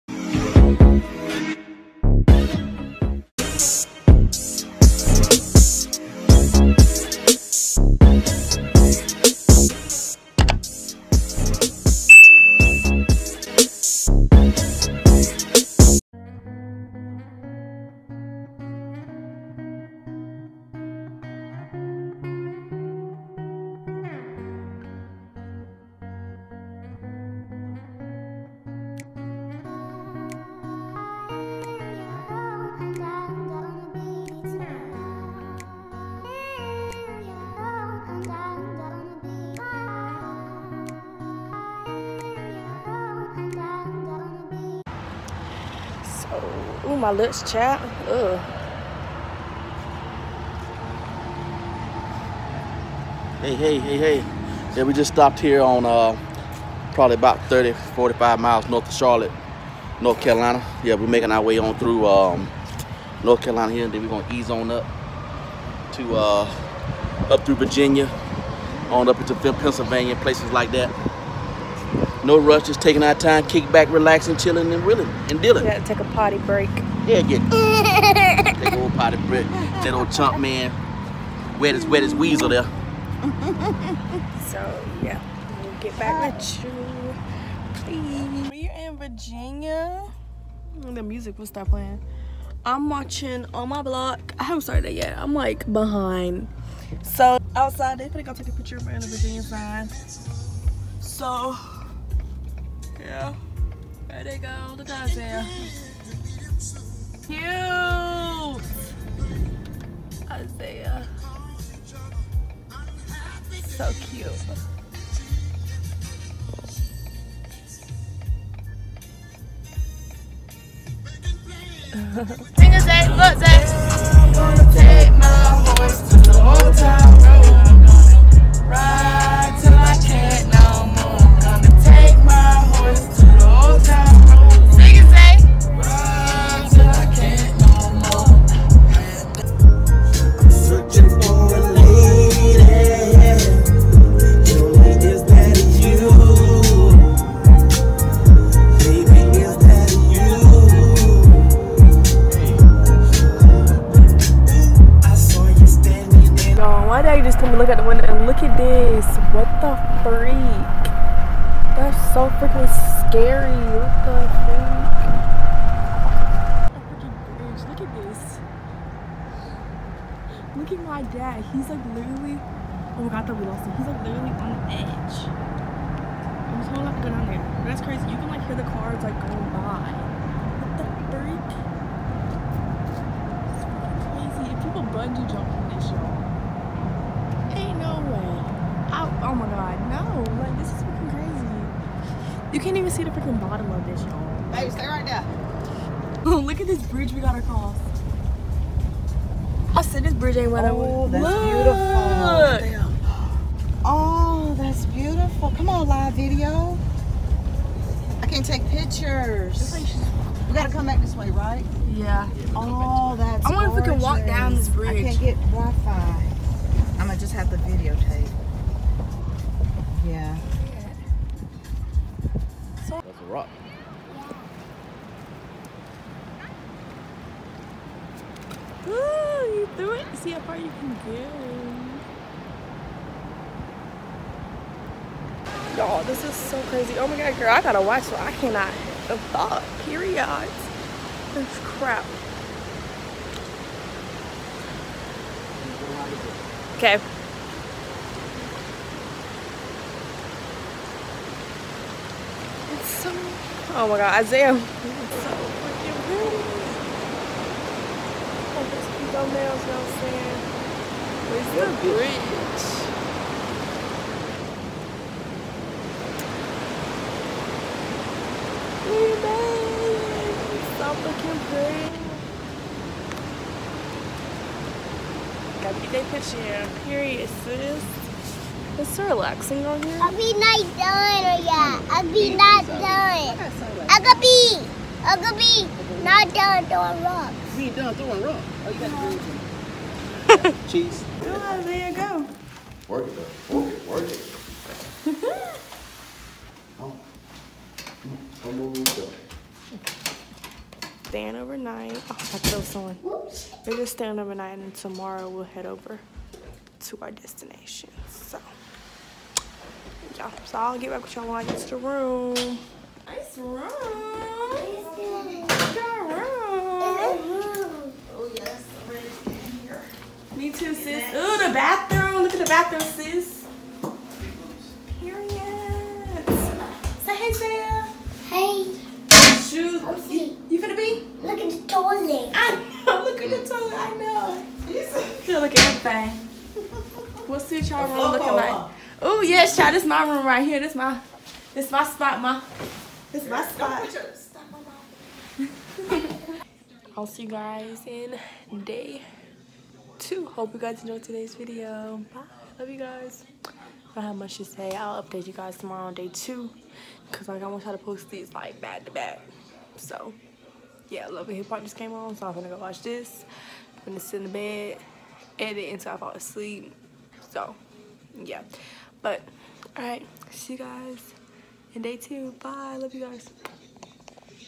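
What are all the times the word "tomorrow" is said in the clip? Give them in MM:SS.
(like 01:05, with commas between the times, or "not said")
05:04, 05:55.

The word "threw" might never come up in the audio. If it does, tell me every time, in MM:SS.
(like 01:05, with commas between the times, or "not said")
03:49.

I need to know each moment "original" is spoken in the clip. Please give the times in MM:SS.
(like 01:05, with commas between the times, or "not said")
not said.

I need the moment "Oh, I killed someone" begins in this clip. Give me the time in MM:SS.
05:02.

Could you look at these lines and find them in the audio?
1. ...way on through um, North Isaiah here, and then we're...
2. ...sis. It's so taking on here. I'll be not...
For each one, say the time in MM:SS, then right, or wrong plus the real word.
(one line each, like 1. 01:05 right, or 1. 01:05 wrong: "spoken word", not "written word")
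1. 01:01 wrong: "Carolina", not "Isaiah"
2. 04:37 wrong: "relaxing", not "taking".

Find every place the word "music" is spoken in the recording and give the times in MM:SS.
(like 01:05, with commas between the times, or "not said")
01:31.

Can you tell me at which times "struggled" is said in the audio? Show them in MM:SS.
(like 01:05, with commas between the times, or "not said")
not said.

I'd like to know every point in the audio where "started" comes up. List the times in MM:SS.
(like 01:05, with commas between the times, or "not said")
01:34.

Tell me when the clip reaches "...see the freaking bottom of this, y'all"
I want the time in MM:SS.
03:12.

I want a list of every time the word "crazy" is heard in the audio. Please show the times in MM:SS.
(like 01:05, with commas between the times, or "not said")
02:57, 03:04, 03:56.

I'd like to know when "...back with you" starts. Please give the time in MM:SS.
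01:25.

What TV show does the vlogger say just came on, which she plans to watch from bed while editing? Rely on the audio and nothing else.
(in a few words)
Love Hip Hop.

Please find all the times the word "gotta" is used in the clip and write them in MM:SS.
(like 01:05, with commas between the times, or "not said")
03:30, 03:57, 04:35.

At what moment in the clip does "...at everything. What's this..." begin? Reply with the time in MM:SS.
05:35.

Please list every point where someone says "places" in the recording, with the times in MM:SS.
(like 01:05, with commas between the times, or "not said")
01:10.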